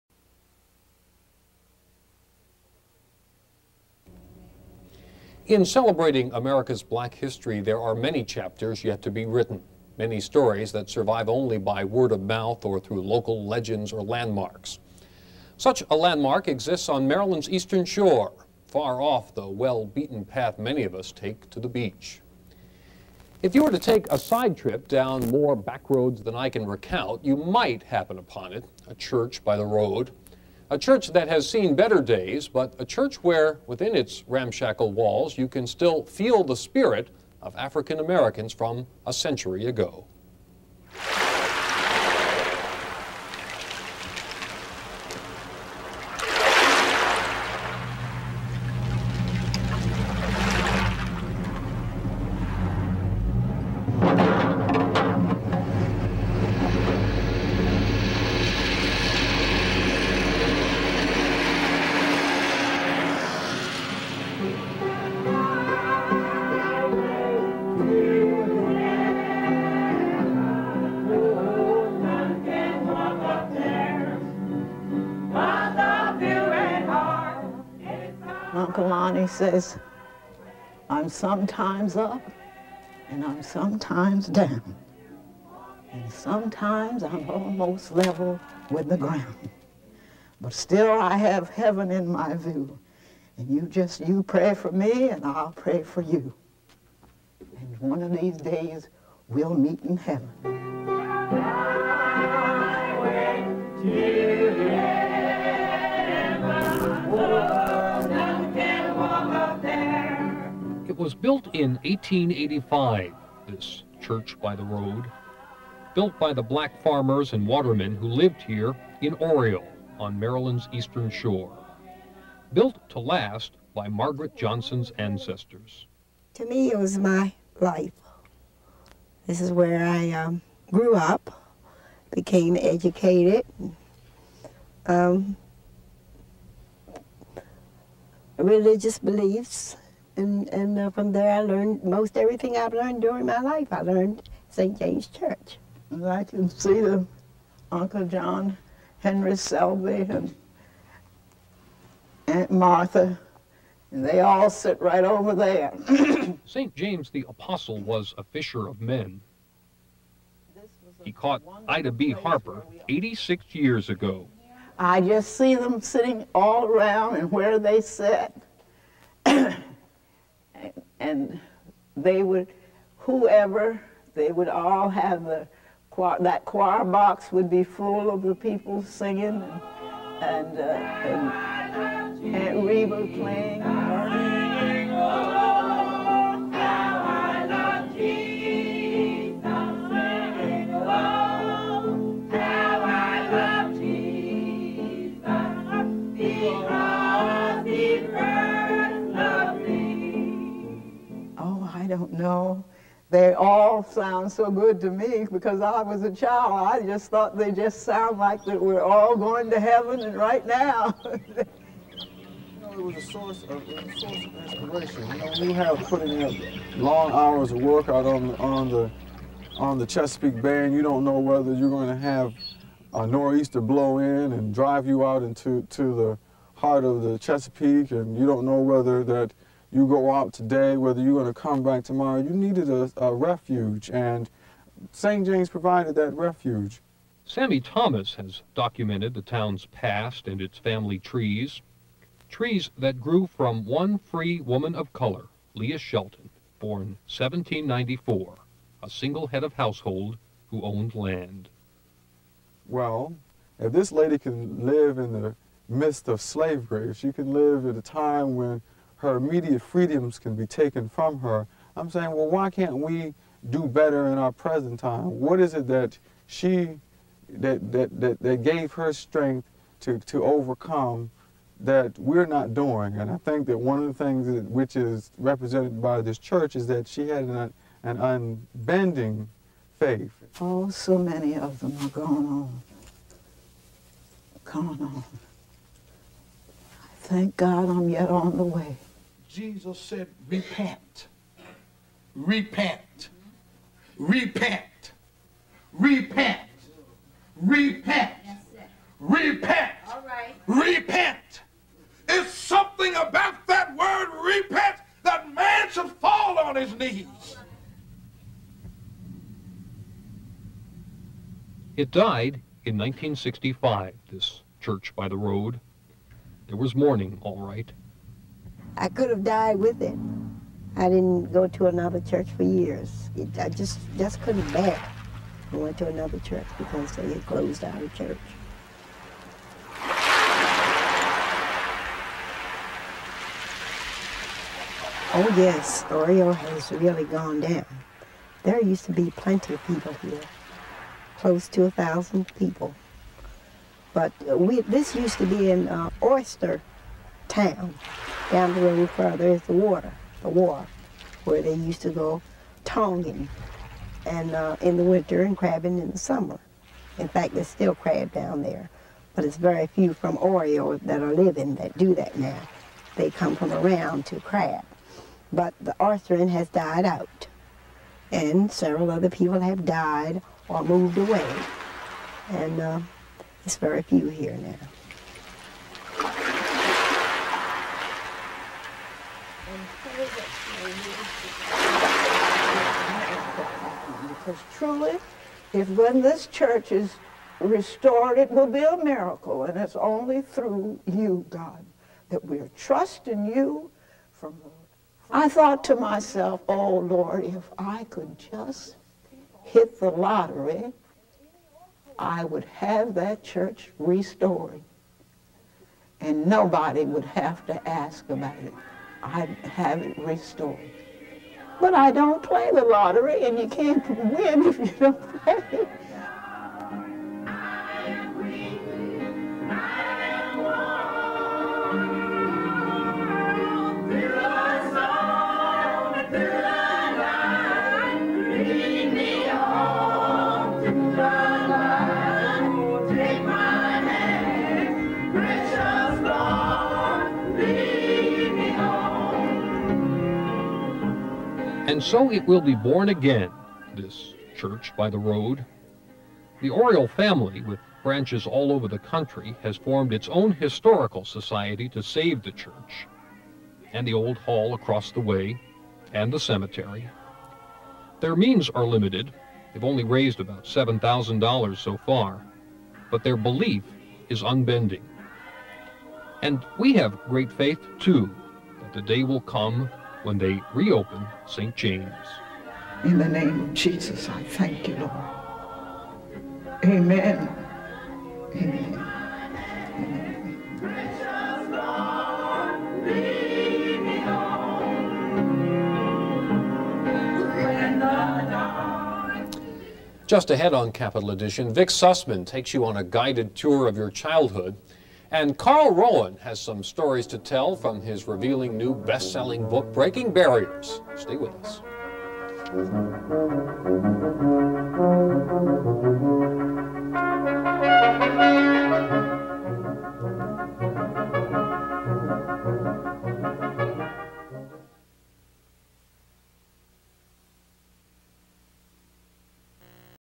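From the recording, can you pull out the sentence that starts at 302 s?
It's something about that word repent that man should fall on his knees.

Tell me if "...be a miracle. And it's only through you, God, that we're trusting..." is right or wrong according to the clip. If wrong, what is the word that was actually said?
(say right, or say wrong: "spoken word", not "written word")
right.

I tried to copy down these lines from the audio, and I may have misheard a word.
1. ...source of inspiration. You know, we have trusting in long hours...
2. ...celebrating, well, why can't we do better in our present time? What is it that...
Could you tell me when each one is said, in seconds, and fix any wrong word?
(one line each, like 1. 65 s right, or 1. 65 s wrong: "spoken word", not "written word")
1. 213 s wrong: "putting", not "trusting"
2. 261 s wrong: "saying", not "celebrating".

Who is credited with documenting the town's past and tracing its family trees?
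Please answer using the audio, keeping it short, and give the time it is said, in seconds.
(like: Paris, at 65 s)
Sammy Thomas, at 237 s.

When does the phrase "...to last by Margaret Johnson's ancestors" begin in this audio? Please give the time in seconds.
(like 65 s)
122 s.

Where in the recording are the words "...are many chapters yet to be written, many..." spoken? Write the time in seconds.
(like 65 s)
7 s.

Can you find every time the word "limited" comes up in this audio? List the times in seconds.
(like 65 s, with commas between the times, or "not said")
458 s.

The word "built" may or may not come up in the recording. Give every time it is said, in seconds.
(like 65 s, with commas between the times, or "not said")
111 s, 115 s, 122 s.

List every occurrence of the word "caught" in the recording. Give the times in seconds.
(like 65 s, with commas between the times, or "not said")
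161 s.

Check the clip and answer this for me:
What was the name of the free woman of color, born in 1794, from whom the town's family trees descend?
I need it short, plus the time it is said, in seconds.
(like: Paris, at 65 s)
Leah Shelton, at 245 s.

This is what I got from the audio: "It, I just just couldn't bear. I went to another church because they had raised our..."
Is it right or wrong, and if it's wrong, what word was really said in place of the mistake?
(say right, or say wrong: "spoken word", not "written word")
wrong: "closed", not "raised".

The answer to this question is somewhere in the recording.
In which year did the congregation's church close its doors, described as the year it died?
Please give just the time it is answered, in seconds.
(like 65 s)
312 s.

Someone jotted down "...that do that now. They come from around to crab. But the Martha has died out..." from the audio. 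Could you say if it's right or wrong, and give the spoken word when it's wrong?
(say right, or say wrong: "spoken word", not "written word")
wrong: "Arthurian", not "Martha".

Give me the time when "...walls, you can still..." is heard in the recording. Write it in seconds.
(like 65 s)
34 s.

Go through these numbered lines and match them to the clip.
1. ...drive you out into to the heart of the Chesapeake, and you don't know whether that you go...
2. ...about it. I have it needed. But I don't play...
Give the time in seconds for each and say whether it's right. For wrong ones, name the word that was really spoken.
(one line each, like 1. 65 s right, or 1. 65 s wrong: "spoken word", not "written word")
1. 224 s right
2. 408 s wrong: "restored", not "needed".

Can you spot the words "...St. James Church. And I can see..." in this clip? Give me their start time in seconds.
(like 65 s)
144 s.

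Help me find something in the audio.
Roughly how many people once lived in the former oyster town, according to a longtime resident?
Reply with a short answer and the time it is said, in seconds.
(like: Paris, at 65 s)
1,000, at 341 s.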